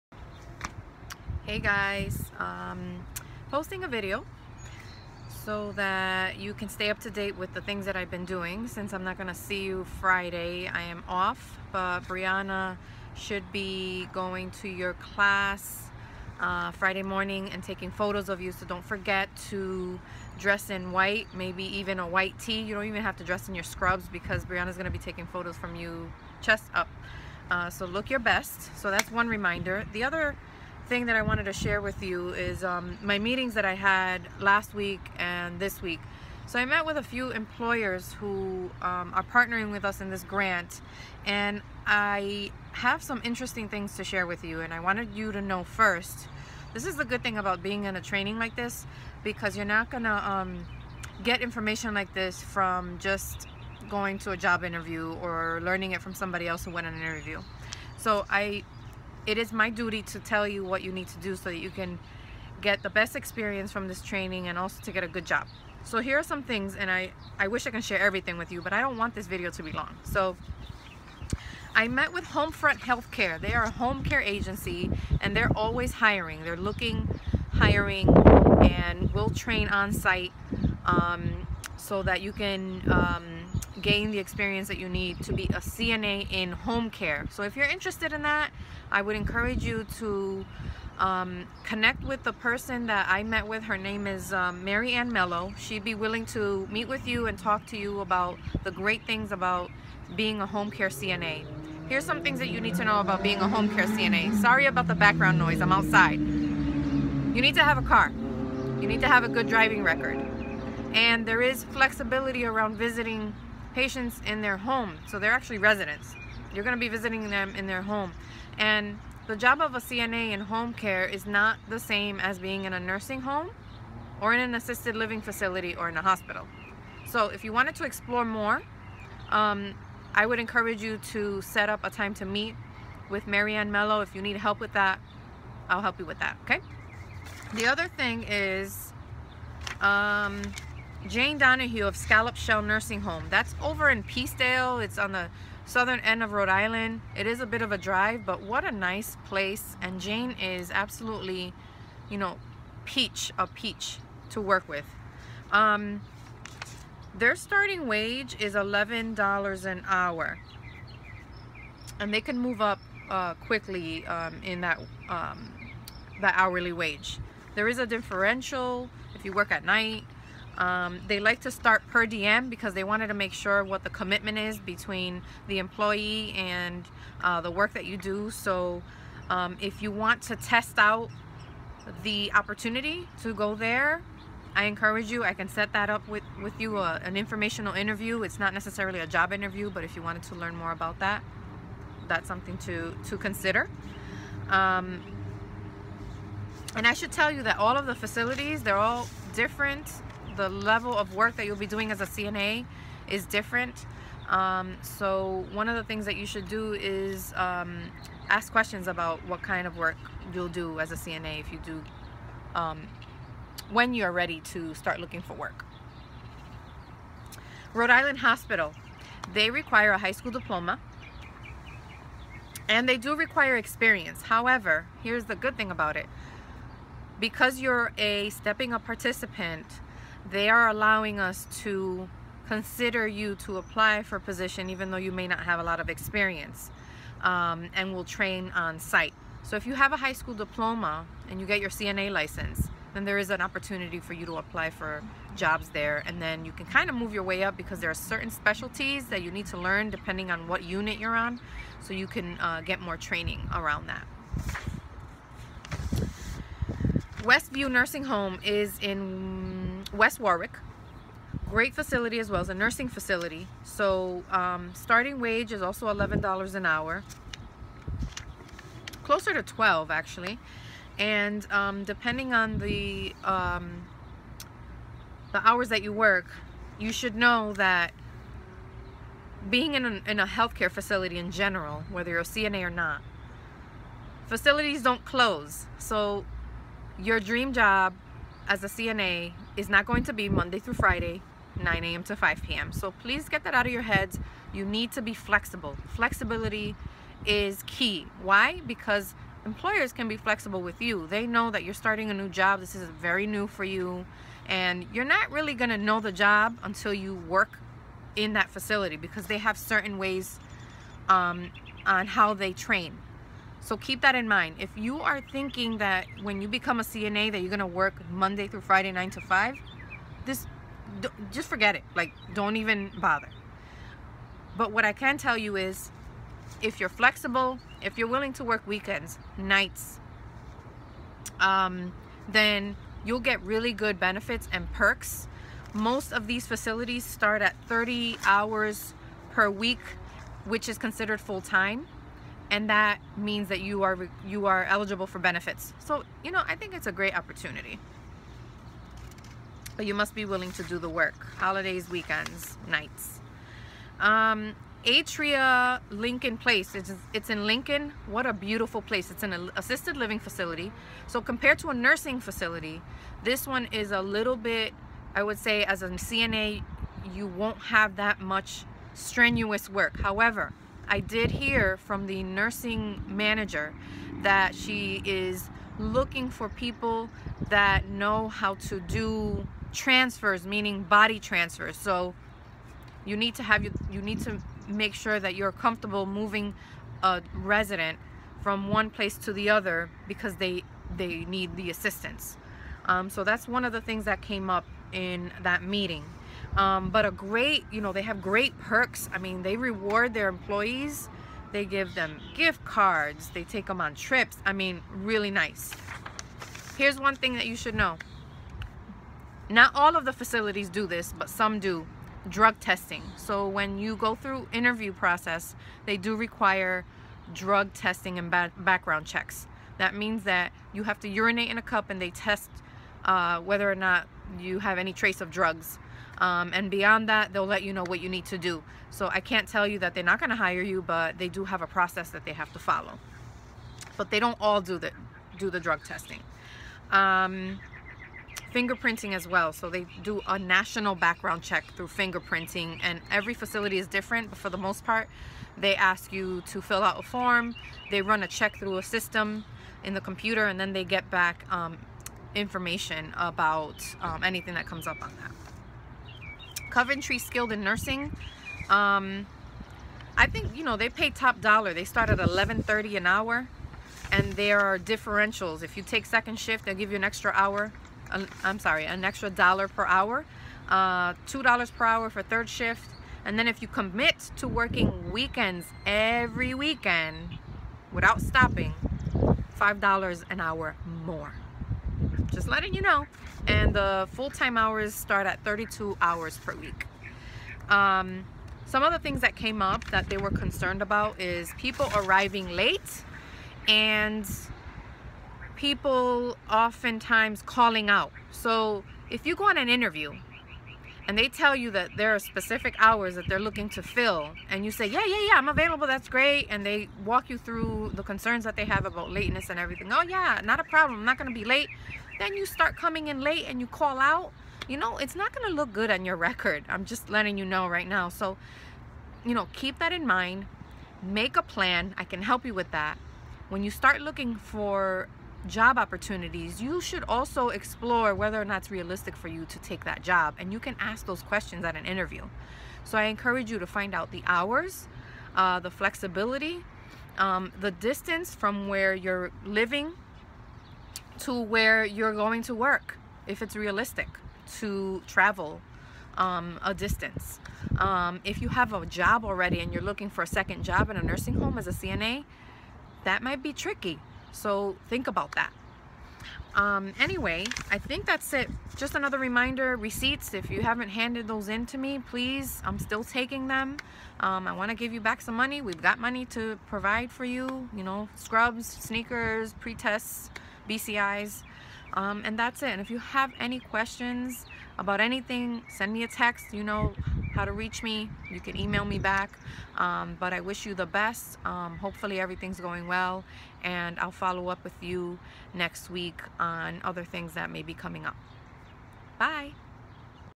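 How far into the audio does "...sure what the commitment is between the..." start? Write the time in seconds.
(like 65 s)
173 s.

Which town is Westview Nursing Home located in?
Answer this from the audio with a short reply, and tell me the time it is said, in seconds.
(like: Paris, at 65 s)
West Warwick, at 259 s.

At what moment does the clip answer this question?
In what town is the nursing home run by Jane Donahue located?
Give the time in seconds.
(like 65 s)
144 s.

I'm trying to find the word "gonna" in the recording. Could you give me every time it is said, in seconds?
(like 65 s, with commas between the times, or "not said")
9 s, 24 s, 317 s, 511 s.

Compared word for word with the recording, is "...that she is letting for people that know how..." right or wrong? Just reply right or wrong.
wrong.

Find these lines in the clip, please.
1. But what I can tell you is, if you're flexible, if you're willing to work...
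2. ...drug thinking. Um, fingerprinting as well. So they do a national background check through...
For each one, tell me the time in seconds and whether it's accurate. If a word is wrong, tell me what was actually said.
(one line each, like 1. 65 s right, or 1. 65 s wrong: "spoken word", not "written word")
1. 324 s right
2. 435 s wrong: "testing", not "thinking".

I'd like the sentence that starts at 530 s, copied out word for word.
And you can ask those questions at an interview.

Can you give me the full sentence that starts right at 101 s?
Here's some things that you need to know about being a home care CNA.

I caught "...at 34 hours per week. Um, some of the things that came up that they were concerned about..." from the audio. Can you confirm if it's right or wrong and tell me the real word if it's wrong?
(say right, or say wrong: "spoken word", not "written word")
wrong: "32", not "34".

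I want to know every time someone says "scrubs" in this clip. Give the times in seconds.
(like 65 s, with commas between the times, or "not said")
23 s, 568 s.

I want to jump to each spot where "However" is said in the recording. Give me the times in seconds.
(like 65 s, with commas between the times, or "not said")
224 s, 370 s.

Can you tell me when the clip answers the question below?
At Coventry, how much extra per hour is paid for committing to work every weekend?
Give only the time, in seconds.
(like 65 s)
479 s.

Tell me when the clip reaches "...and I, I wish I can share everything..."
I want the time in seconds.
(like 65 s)
66 s.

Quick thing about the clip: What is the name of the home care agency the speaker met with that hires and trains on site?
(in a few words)
Homefront Healthcare.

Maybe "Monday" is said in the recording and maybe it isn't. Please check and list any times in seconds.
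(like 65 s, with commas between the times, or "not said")
290 s, 318 s.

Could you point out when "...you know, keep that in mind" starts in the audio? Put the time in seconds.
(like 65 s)
519 s.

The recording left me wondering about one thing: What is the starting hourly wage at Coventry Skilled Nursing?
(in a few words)
$11.30.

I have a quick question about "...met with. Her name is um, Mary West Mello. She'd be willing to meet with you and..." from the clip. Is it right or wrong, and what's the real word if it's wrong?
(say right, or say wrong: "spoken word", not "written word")
wrong: "Ann", not "West".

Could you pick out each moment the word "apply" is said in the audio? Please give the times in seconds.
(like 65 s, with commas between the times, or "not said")
233 s, 244 s.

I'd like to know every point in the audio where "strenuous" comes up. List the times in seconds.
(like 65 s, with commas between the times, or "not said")
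368 s.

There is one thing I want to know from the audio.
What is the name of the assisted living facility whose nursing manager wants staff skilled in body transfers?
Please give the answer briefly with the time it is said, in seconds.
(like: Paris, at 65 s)
Atria Lincoln Place, at 354 s.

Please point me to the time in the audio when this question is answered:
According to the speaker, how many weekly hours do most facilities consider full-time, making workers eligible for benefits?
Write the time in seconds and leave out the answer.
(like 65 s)
337 s.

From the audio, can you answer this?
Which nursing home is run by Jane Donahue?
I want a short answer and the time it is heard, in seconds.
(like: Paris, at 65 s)
Scallop Shell Nursing Home, at 141 s.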